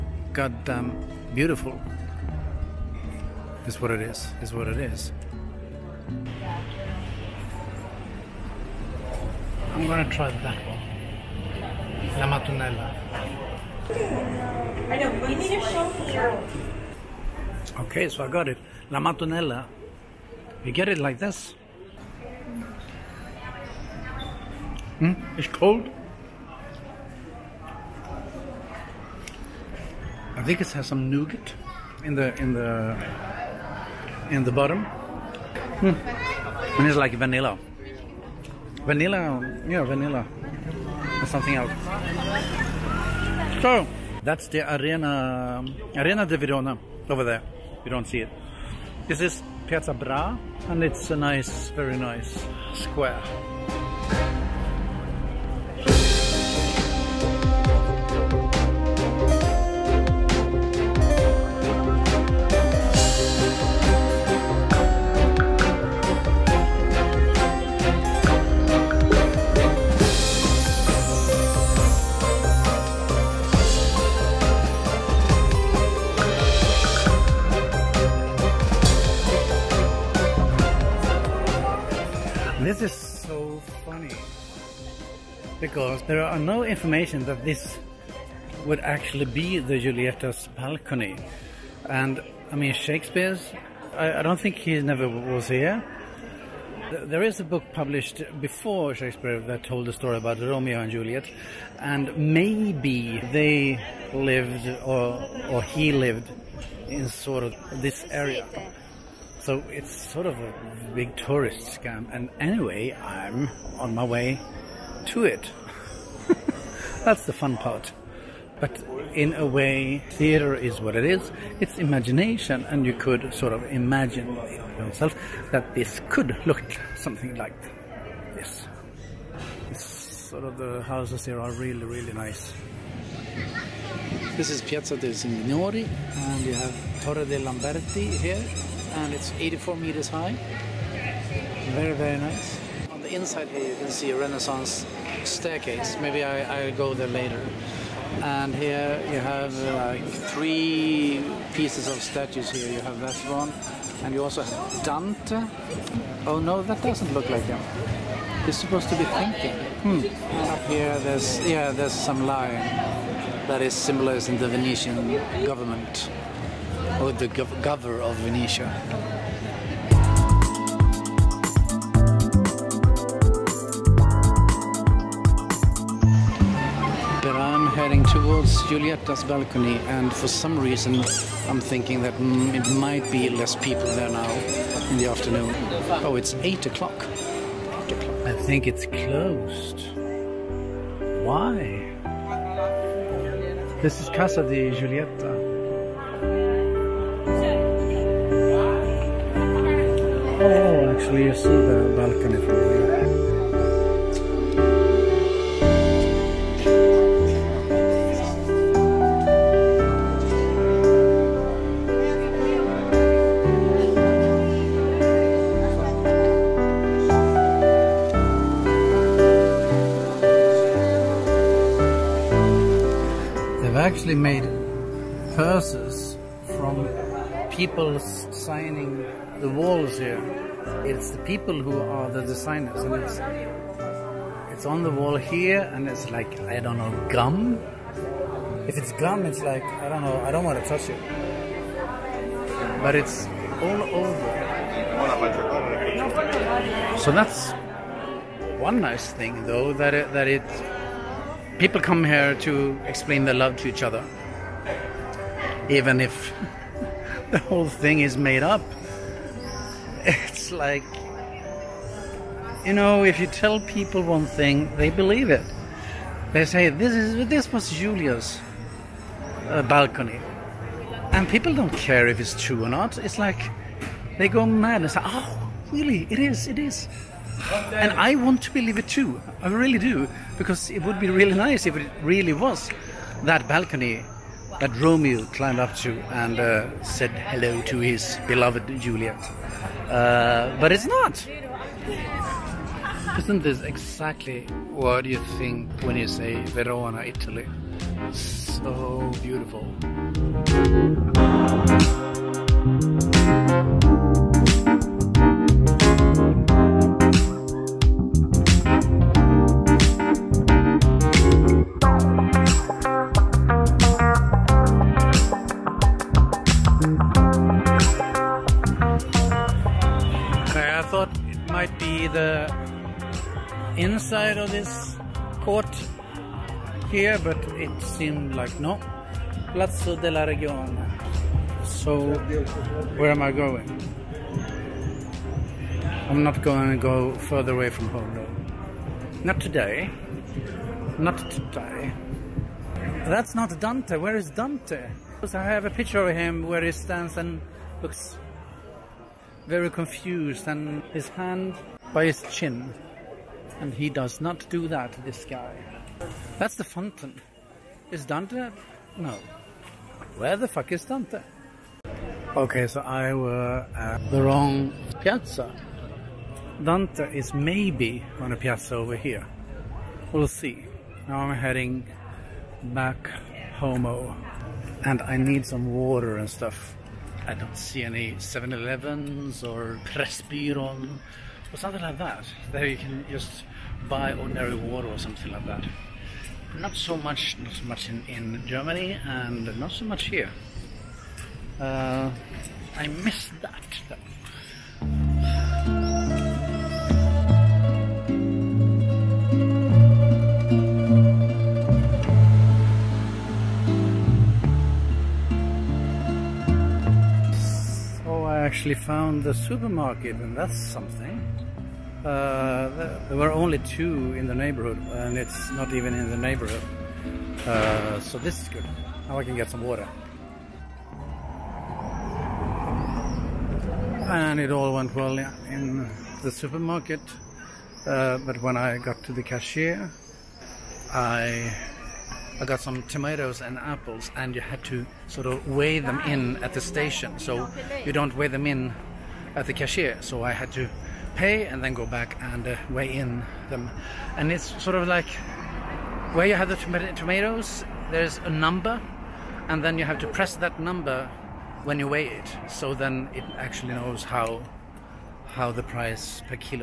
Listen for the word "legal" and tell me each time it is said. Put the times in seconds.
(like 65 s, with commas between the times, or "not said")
not said.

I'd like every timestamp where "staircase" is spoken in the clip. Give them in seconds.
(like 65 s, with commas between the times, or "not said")
145 s.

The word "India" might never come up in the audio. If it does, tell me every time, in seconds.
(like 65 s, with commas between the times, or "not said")
not said.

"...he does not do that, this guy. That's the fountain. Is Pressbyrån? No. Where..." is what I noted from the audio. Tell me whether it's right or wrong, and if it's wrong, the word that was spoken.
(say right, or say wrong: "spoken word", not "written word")
wrong: "Dante", not "Pressbyrån".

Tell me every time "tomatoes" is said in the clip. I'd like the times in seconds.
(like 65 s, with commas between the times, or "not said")
432 s, 446 s.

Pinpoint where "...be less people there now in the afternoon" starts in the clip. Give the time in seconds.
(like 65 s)
183 s.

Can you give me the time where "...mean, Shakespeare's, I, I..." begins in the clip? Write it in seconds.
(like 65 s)
92 s.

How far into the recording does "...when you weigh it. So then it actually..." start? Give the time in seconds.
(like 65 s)
451 s.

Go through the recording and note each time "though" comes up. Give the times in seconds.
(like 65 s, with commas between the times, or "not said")
249 s, 338 s.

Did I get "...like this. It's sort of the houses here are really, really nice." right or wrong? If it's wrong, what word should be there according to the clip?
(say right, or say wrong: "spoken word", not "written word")
right.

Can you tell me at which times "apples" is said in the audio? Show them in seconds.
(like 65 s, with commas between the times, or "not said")
433 s.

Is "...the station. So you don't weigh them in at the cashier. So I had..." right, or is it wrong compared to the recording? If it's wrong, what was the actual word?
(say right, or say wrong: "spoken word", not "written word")
right.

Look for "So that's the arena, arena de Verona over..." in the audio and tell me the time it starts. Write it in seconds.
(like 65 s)
43 s.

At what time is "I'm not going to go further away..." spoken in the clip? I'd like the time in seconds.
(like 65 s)
336 s.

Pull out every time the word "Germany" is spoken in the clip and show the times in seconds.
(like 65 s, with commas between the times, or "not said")
388 s.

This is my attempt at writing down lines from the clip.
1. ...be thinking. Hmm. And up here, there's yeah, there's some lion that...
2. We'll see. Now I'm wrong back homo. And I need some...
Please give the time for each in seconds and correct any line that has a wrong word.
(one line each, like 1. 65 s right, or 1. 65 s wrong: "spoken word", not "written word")
1. 158 s right
2. 370 s wrong: "heading", not "wrong".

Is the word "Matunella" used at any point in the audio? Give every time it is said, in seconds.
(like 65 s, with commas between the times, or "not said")
12 s, 18 s.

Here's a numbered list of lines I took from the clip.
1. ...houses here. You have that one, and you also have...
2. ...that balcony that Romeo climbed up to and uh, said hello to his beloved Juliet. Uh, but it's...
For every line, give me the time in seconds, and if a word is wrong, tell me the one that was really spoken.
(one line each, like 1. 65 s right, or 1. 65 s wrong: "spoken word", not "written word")
1. 152 s wrong: "statues", not "houses"
2. 283 s right.